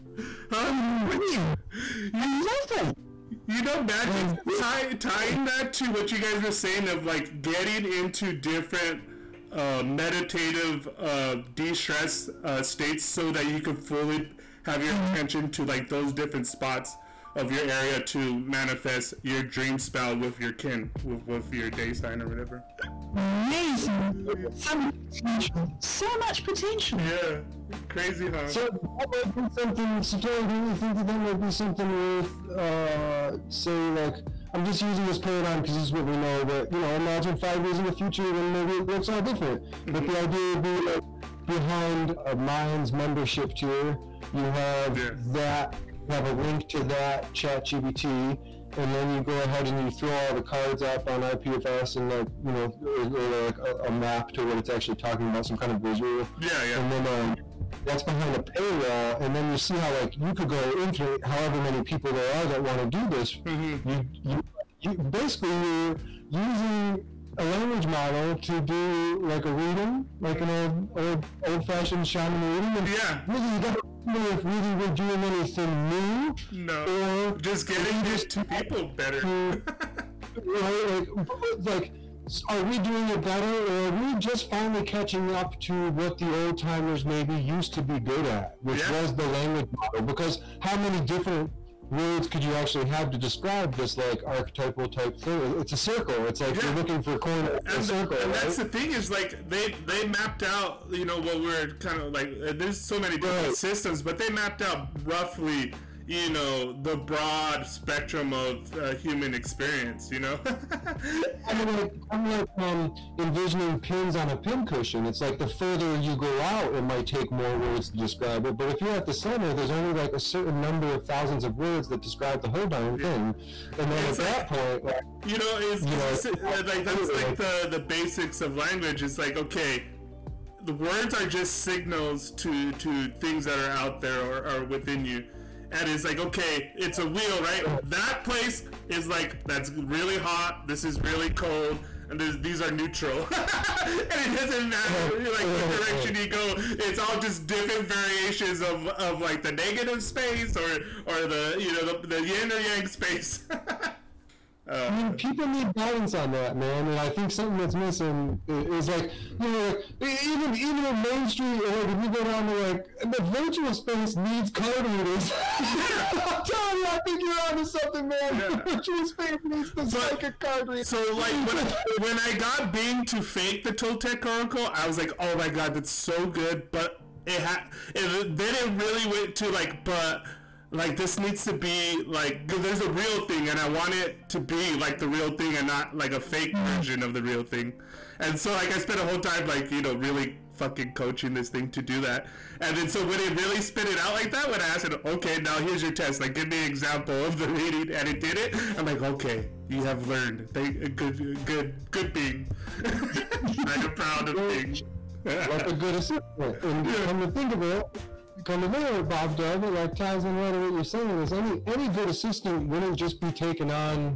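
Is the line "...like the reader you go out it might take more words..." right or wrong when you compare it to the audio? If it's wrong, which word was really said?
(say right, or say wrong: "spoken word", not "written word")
wrong: "further", not "reader".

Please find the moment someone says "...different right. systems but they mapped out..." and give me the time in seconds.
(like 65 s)
103 s.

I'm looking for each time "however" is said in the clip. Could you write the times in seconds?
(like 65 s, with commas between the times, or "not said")
61 s.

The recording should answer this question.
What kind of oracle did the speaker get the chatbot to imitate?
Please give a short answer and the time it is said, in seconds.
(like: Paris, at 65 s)
Toltec Oracle, at 173 s.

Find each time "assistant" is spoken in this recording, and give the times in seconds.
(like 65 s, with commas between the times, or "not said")
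205 s, 212 s.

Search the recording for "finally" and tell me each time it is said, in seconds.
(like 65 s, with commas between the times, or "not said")
84 s.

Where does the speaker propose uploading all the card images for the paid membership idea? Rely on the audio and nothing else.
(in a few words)
IPFS.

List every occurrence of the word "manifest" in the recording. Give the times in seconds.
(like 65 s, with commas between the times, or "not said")
18 s.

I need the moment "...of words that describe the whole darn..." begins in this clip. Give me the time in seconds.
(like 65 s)
121 s.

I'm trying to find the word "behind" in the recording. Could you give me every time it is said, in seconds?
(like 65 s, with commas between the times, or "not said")
41 s, 58 s.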